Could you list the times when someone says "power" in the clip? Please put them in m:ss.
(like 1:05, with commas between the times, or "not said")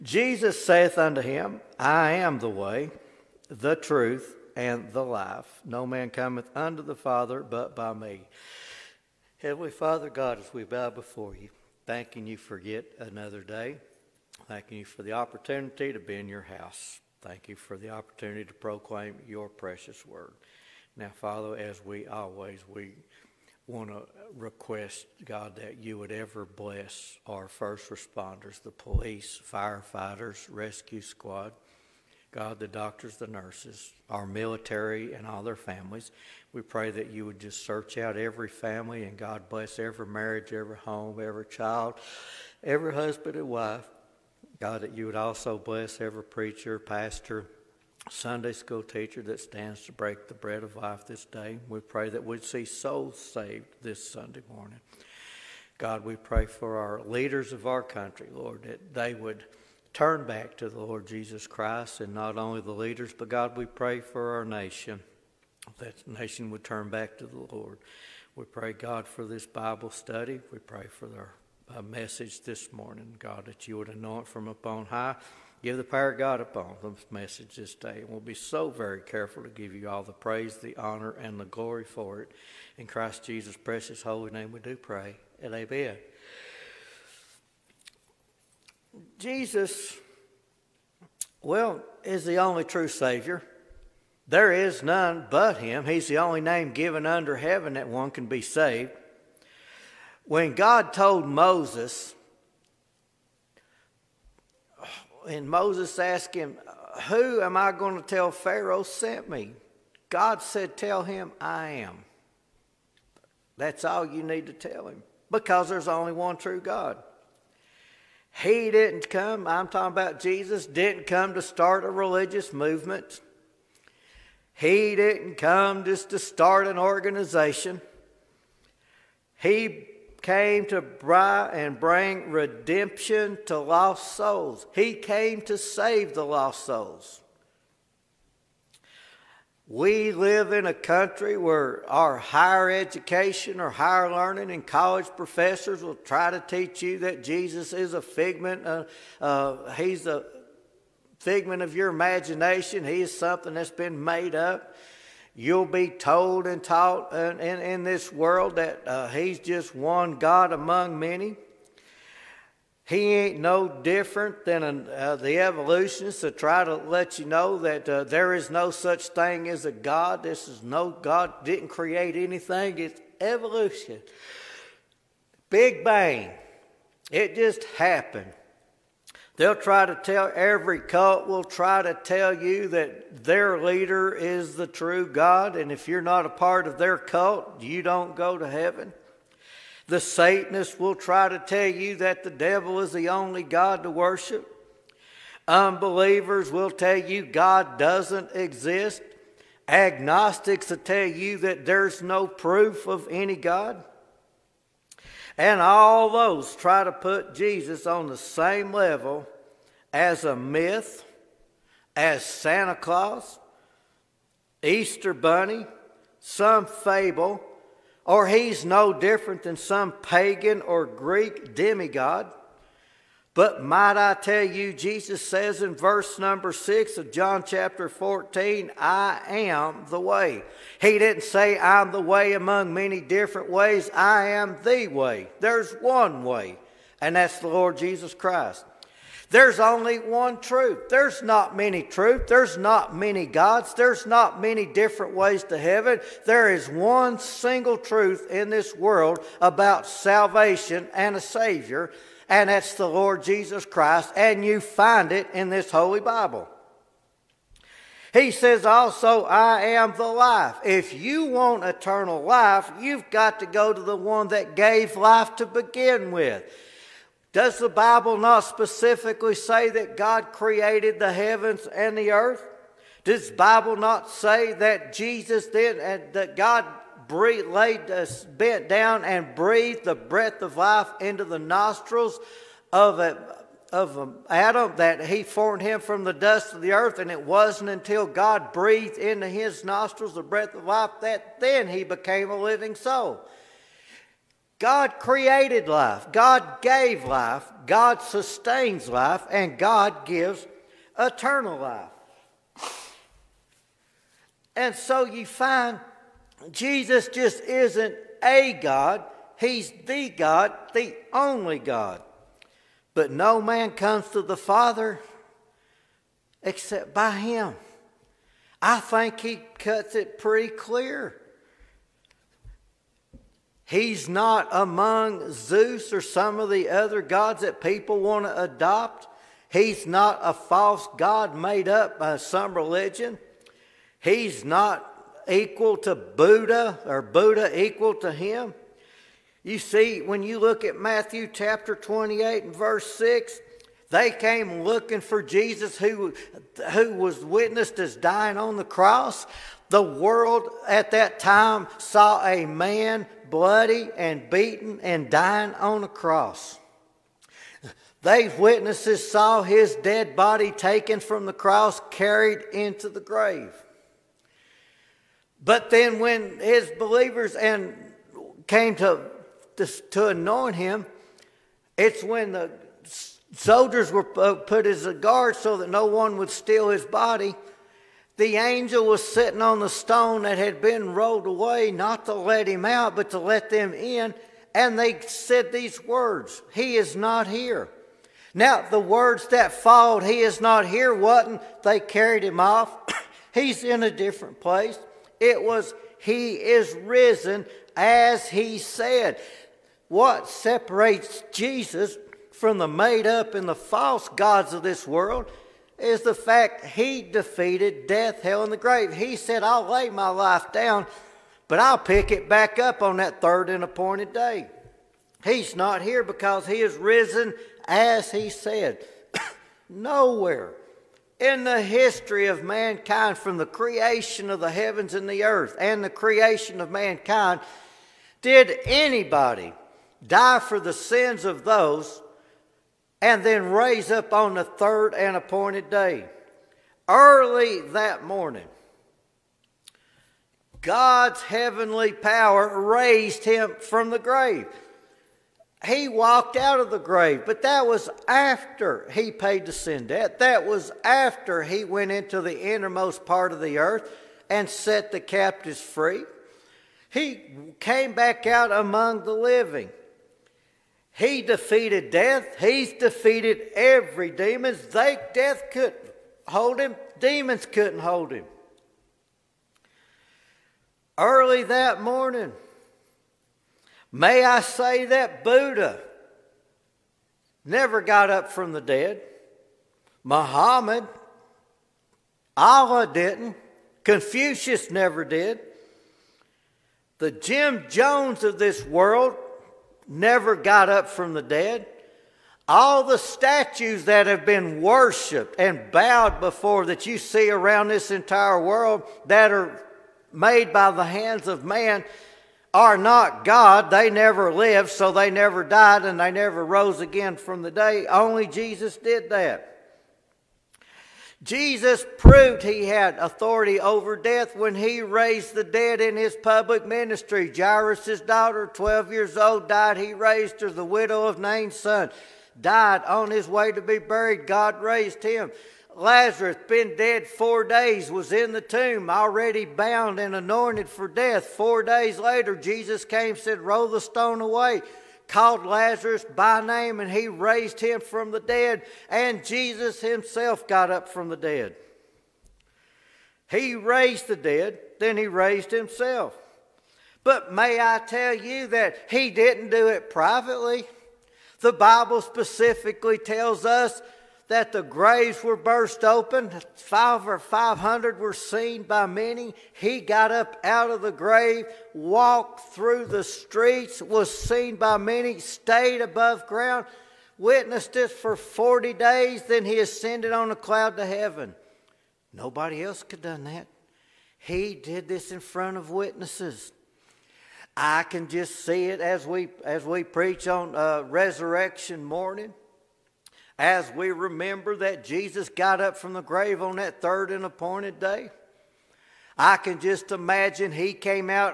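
1:15, 7:21.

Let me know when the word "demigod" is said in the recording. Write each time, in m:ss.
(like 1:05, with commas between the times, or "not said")
3:41.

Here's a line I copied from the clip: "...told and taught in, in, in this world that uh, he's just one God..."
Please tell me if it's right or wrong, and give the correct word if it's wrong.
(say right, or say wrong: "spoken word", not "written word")
right.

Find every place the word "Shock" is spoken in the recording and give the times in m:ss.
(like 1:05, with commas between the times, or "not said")
not said.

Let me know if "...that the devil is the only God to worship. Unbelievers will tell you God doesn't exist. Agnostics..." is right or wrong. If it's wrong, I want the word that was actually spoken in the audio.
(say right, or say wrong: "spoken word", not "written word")
right.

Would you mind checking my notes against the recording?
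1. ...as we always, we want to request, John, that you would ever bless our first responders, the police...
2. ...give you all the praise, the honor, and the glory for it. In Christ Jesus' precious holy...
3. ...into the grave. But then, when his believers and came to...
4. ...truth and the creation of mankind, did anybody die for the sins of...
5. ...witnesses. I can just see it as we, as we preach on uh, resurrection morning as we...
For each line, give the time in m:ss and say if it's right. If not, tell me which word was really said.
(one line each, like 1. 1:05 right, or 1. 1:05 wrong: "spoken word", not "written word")
1. 0:21 wrong: "God", not "John"
2. 1:19 right
3. 6:02 right
4. 7:05 wrong: "earth", not "truth"
5. 9:35 right.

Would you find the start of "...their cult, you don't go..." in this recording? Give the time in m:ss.
3:06.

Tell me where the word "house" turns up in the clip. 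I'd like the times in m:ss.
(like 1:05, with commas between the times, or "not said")
0:16.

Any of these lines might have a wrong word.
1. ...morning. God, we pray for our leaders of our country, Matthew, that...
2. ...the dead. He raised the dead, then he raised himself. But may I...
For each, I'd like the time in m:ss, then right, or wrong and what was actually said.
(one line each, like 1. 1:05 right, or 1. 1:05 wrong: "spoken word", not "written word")
1. 0:54 wrong: "Lord", not "Matthew"
2. 9:01 right.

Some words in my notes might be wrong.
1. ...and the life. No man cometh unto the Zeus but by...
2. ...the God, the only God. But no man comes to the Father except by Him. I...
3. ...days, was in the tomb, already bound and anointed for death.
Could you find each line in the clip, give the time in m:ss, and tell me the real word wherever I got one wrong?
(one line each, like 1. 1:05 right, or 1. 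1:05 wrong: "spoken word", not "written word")
1. 0:04 wrong: "Father", not "Zeus"
2. 5:09 right
3. 8:47 right.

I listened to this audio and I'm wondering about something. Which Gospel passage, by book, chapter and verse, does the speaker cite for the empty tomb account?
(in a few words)
Matthew 28:6.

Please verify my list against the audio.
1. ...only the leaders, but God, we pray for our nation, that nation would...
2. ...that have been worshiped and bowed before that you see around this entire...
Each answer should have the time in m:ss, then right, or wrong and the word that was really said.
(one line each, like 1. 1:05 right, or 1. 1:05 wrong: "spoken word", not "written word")
1. 1:02 right
2. 8:13 right.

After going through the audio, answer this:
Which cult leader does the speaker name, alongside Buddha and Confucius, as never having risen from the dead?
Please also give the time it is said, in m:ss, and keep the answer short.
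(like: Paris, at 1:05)
Jim Jones, at 8:07.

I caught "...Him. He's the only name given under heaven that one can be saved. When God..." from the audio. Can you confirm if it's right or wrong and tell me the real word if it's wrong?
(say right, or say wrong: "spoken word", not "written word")
right.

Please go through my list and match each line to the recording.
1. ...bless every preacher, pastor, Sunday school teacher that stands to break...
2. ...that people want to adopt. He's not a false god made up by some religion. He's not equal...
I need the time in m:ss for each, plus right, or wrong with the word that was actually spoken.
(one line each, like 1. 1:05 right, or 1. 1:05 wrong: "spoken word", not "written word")
1. 0:45 right
2. 5:27 right.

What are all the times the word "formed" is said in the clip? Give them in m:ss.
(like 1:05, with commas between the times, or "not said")
4:45.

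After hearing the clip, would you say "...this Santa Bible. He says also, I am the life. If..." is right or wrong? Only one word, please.
wrong.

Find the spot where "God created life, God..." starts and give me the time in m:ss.
4:54.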